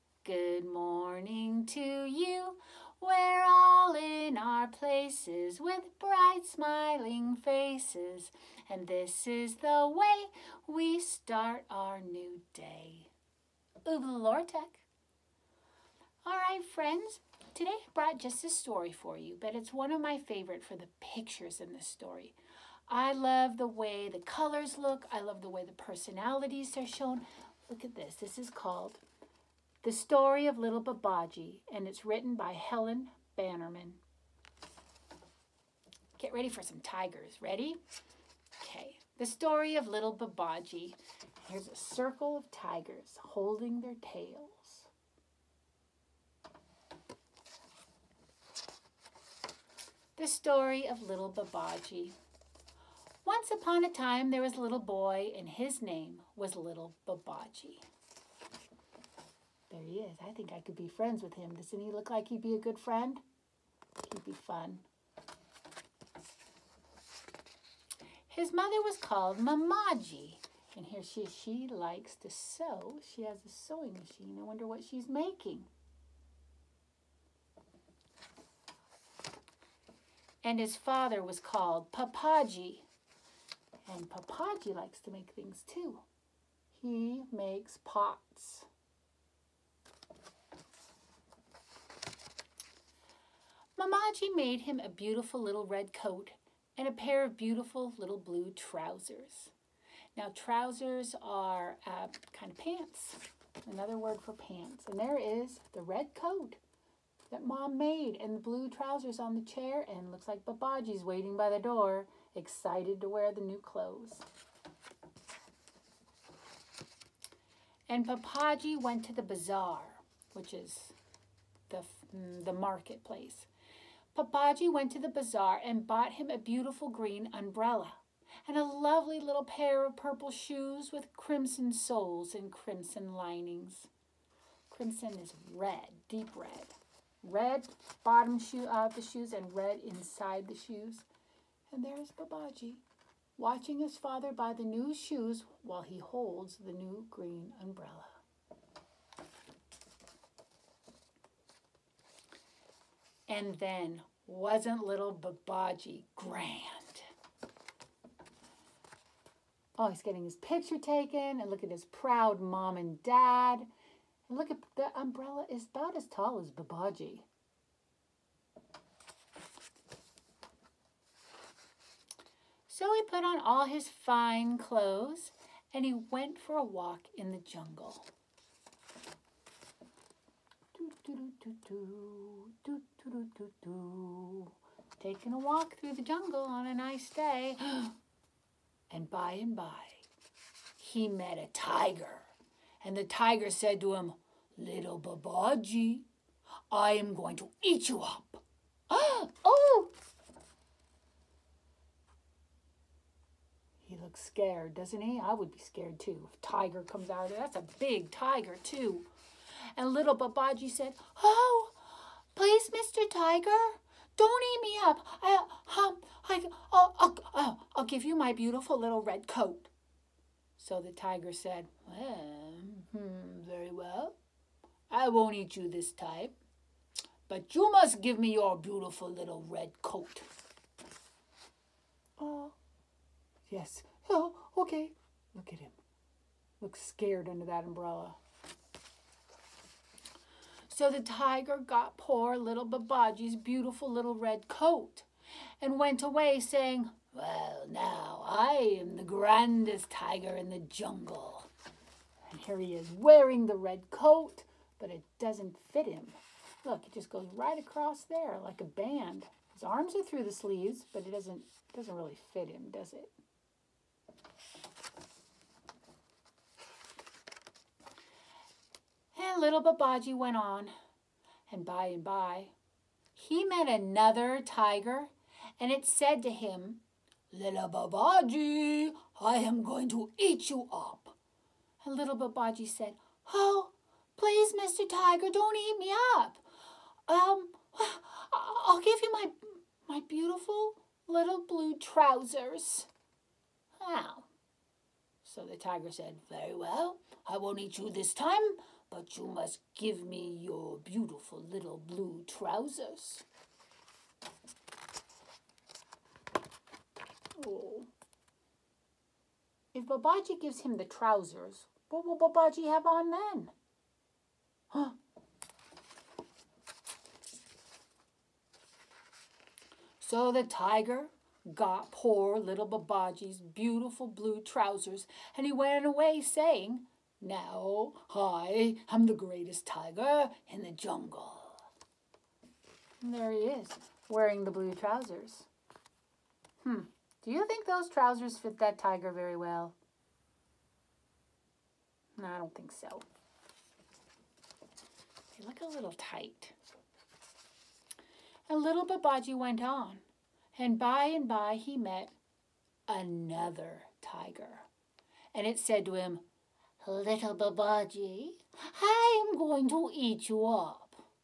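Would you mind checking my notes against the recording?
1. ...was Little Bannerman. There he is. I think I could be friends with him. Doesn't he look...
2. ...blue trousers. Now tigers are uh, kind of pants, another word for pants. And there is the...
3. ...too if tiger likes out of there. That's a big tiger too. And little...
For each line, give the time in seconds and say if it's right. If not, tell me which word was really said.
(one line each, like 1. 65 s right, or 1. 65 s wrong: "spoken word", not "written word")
1. 56 s wrong: "Babaji", not "Bannerman"
2. 98 s wrong: "trousers", not "tigers"
3. 205 s wrong: "comes", not "likes".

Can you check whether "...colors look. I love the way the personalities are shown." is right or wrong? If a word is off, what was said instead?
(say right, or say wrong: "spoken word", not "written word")
right.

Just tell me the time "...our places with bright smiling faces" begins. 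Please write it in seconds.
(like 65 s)
4 s.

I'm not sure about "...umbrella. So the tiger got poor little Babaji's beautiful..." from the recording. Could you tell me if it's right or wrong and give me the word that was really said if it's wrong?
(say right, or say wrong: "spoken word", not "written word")
right.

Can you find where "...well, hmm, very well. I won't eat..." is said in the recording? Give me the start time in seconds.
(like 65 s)
221 s.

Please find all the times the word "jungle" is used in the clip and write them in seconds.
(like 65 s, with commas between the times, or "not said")
177 s, 186 s, 250 s, 330 s.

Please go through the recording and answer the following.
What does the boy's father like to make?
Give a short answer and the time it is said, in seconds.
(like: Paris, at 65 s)
Pots, at 87 s.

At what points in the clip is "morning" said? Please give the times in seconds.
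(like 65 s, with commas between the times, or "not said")
0 s.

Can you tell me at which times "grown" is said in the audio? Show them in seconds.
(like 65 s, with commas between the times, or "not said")
not said.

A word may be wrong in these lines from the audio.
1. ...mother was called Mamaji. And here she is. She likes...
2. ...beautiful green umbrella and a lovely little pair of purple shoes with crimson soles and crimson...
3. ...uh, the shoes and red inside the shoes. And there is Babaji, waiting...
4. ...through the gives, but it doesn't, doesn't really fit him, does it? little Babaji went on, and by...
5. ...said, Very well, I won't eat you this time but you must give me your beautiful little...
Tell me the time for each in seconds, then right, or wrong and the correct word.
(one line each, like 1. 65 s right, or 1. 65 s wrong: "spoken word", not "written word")
1. 68 s right
2. 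126 s right
3. 138 s wrong: "watching", not "waiting"
4. 260 s wrong: "sleeves", not "gives"
5. 295 s right.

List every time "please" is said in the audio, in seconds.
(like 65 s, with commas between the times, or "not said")
212 s, 284 s.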